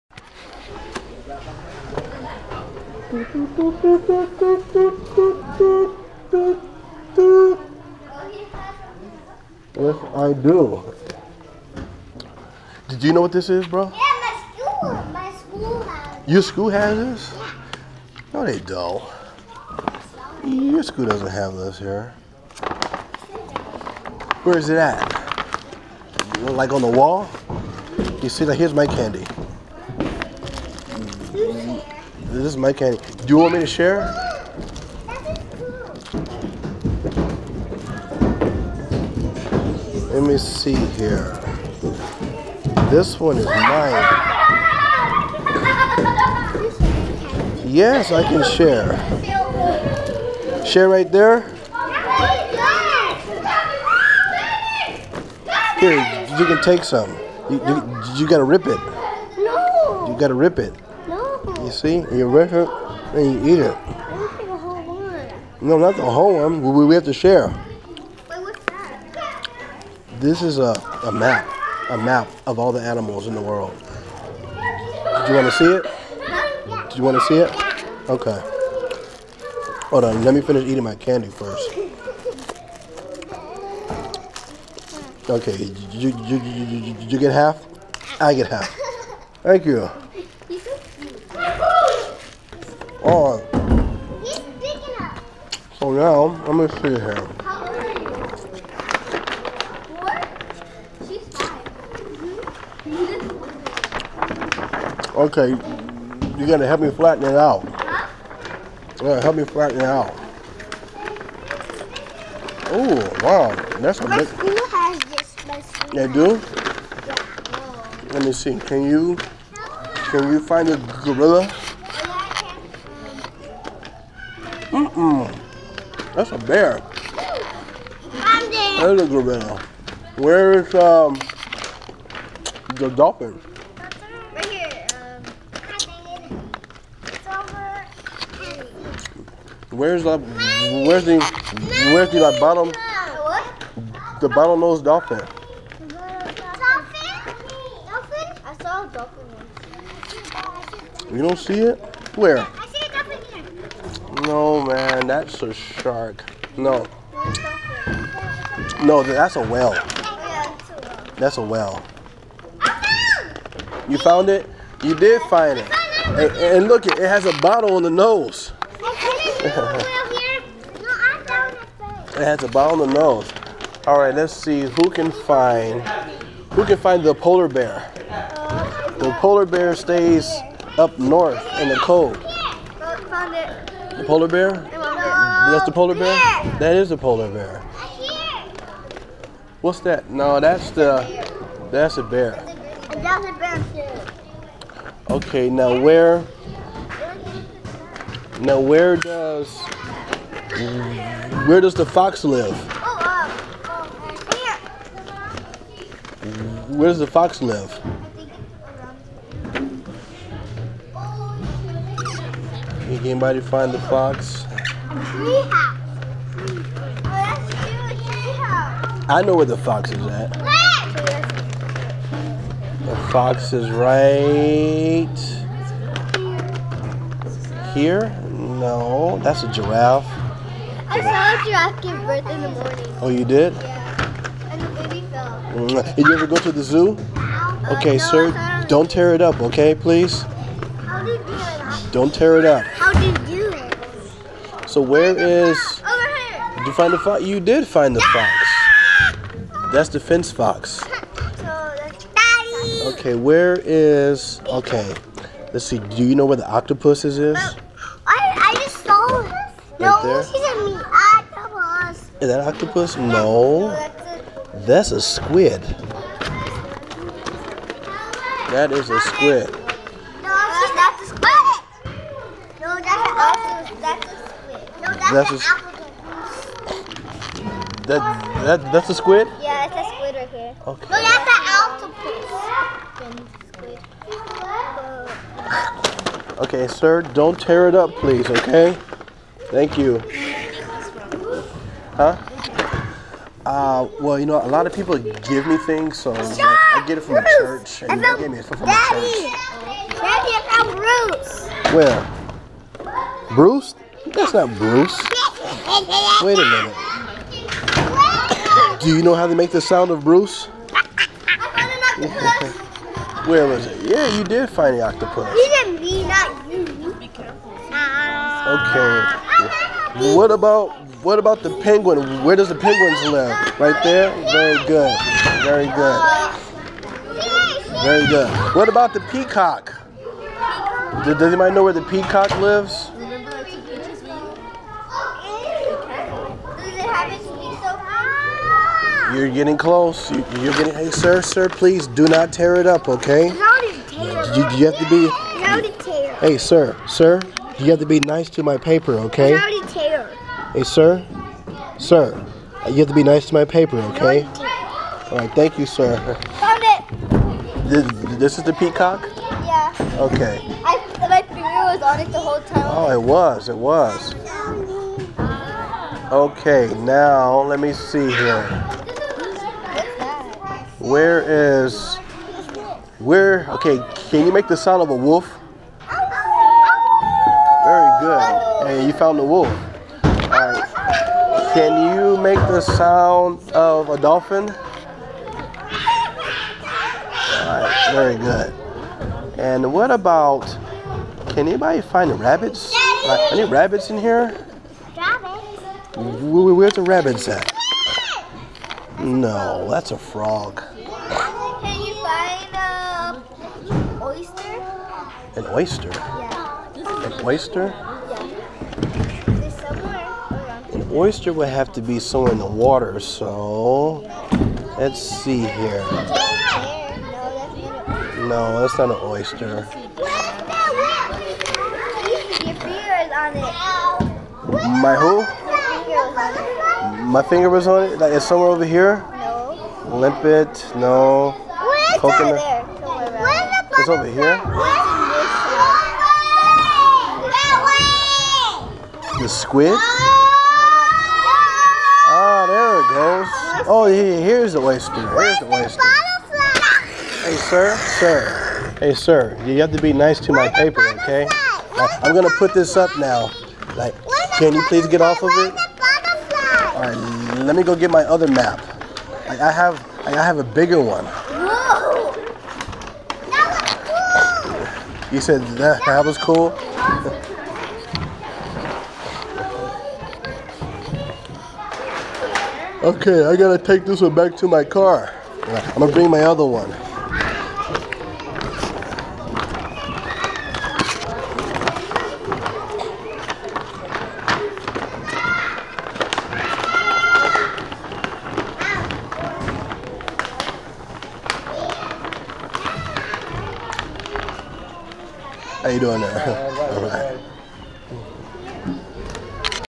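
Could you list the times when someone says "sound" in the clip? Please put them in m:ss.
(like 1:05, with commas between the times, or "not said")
5:09, 6:14, 6:22.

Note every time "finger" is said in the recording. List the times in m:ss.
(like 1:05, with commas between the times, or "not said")
6:01, 7:07.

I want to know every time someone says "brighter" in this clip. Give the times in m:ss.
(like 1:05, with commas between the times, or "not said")
not said.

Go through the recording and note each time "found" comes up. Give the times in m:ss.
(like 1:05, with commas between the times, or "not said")
2:43, 5:00, 5:56, 6:18.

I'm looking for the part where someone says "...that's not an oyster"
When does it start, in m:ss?
6:58.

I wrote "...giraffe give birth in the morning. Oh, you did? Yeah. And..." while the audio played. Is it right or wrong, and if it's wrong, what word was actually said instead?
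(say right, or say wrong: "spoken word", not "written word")
right.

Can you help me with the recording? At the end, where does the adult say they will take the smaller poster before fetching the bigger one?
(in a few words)
car.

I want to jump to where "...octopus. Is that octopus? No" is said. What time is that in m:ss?
4:21.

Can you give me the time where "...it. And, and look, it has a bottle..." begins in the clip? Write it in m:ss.
2:45.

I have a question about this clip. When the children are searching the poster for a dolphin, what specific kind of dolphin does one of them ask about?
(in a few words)
bottlenose dolphin.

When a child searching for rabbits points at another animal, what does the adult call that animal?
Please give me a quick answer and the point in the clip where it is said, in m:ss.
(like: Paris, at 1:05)
frog, at 6:39.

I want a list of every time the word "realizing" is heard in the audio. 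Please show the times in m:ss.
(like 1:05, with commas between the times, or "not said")
not said.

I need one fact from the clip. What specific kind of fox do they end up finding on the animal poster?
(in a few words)
fennec fox.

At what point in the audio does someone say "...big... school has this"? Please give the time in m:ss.
1:54.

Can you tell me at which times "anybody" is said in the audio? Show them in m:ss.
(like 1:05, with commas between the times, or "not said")
3:33, 5:31, 6:31.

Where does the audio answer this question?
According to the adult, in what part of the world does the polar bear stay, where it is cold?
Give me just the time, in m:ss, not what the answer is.
3:00.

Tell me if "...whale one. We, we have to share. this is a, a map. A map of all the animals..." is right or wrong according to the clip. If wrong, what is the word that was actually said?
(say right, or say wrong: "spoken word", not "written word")
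wrong: "whole", not "whale".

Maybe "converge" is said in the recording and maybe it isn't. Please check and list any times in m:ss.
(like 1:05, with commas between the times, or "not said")
not said.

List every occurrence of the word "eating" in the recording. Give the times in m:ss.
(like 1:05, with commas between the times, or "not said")
1:20.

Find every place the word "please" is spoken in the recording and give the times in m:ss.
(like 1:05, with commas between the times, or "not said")
3:59, 4:47, 5:41, 7:34.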